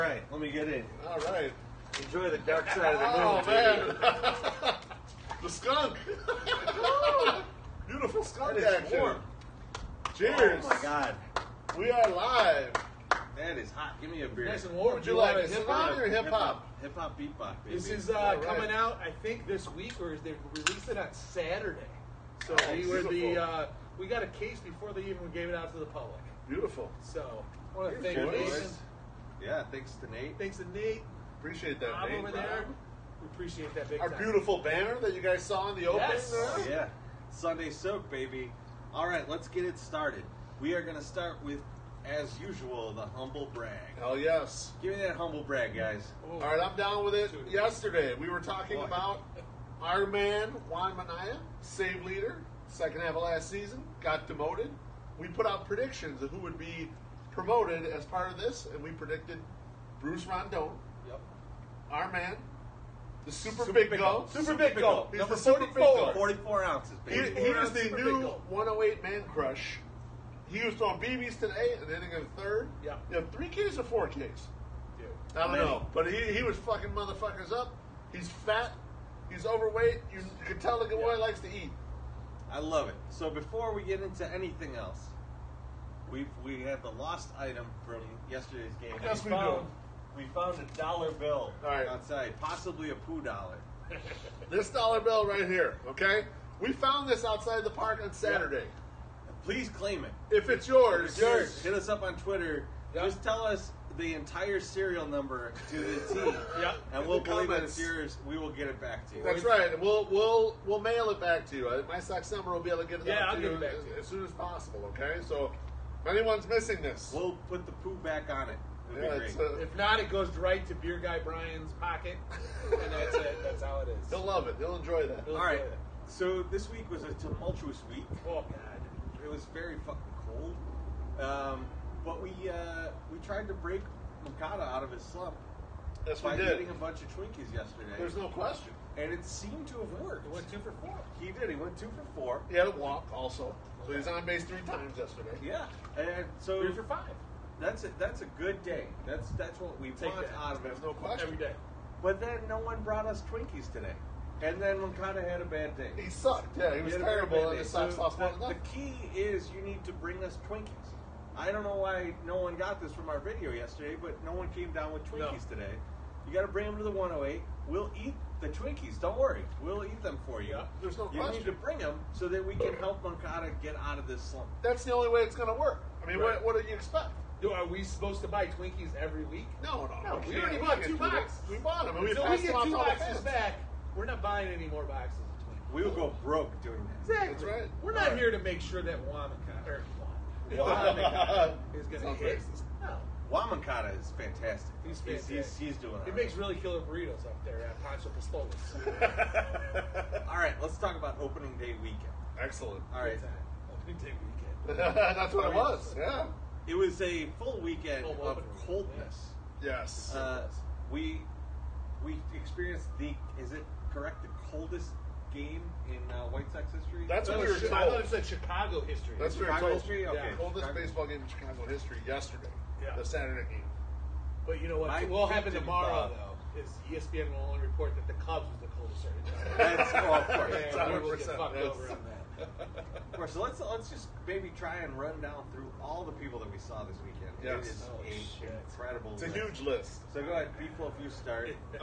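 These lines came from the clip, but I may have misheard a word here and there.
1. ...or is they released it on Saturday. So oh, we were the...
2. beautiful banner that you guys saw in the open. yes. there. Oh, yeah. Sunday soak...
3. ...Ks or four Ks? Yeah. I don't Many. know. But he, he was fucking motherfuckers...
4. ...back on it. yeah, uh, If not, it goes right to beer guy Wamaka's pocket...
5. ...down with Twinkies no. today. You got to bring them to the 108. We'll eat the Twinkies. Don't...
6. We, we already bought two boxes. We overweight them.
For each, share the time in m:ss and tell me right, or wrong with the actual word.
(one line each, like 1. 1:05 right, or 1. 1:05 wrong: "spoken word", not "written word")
1. 0:19 right
2. 0:34 right
3. 1:13 right
4. 1:57 wrong: "Brian", not "Wamaka"
5. 2:44 right
6. 3:00 wrong: "bought", not "overweight".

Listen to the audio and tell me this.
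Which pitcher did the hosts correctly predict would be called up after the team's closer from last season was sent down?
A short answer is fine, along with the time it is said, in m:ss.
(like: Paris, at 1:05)
Bruce Rondon, at 1:00.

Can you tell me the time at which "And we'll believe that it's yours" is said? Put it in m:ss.
1:46.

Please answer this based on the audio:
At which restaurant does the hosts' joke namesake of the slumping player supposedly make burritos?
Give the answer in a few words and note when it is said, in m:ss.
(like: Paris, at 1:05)
Pancho Pistolas, at 3:17.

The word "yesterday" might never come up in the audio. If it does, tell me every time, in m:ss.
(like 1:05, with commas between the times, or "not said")
0:47, 1:28, 2:17, 2:24, 2:43, 3:42.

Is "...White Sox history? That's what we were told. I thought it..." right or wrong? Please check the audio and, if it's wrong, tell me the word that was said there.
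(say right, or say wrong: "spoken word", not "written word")
right.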